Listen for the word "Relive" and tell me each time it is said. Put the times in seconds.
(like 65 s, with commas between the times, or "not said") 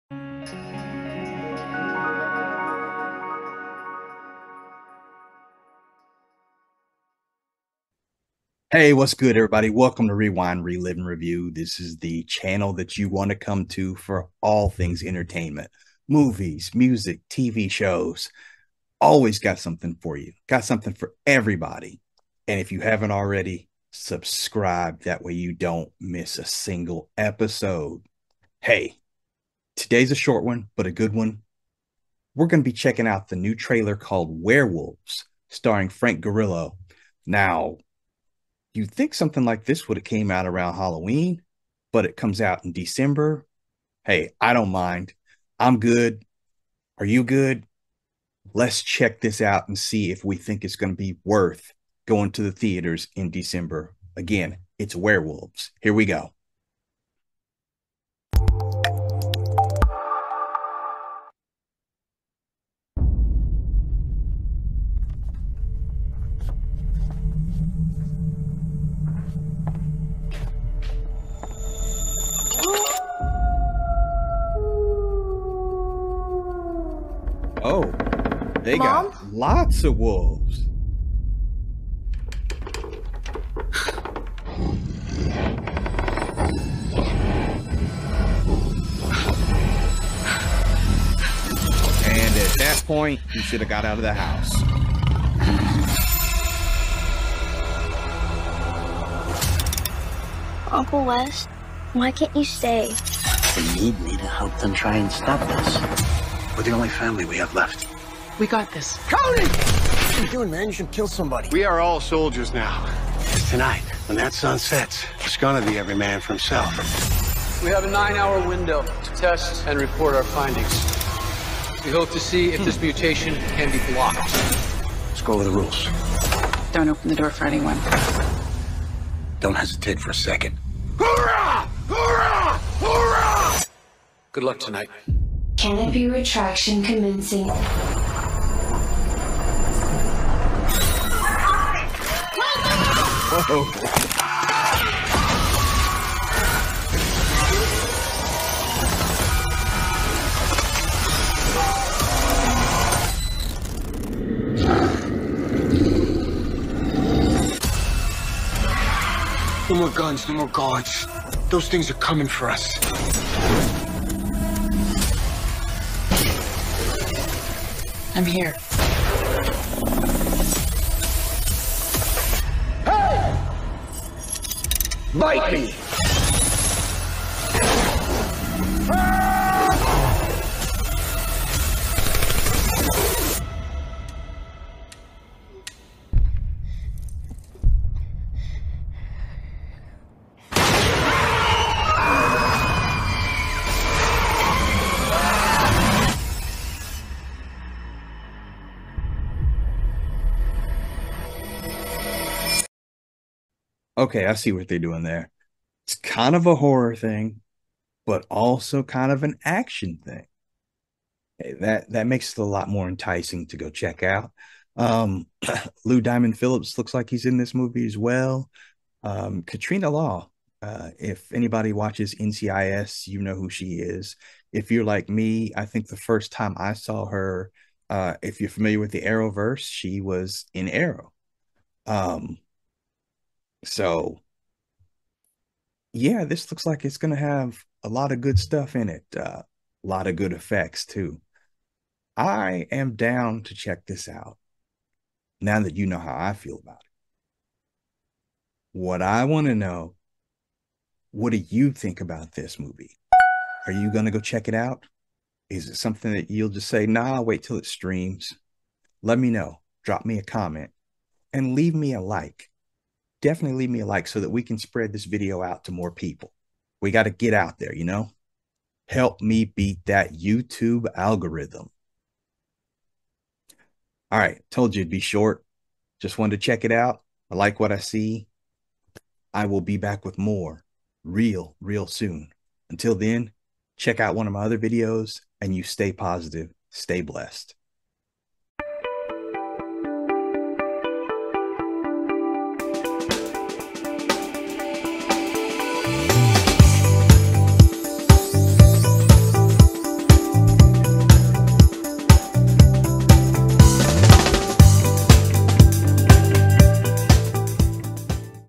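10 s.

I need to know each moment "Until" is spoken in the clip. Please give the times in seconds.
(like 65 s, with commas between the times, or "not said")
282 s.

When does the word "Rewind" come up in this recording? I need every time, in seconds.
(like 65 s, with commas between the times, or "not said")
10 s.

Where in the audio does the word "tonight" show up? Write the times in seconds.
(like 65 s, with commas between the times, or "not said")
113 s, 134 s.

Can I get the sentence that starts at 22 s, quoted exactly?
And if you haven't already, subscribe.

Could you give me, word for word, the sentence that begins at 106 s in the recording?
We're the only family we have left.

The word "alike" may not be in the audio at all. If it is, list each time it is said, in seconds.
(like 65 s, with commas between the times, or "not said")
not said.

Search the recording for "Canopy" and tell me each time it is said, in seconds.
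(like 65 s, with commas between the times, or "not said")
135 s.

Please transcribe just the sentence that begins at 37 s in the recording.
Now, you think something like this would have came out around Halloween, but it comes out in December.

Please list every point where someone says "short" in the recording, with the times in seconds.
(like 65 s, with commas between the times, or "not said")
30 s, 274 s.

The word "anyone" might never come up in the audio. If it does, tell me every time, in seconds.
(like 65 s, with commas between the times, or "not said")
127 s.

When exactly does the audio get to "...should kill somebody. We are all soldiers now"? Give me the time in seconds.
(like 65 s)
110 s.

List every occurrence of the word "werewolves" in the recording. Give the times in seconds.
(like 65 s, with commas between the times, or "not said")
34 s, 54 s.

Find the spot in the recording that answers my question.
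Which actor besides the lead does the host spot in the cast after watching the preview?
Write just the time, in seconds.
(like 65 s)
215 s.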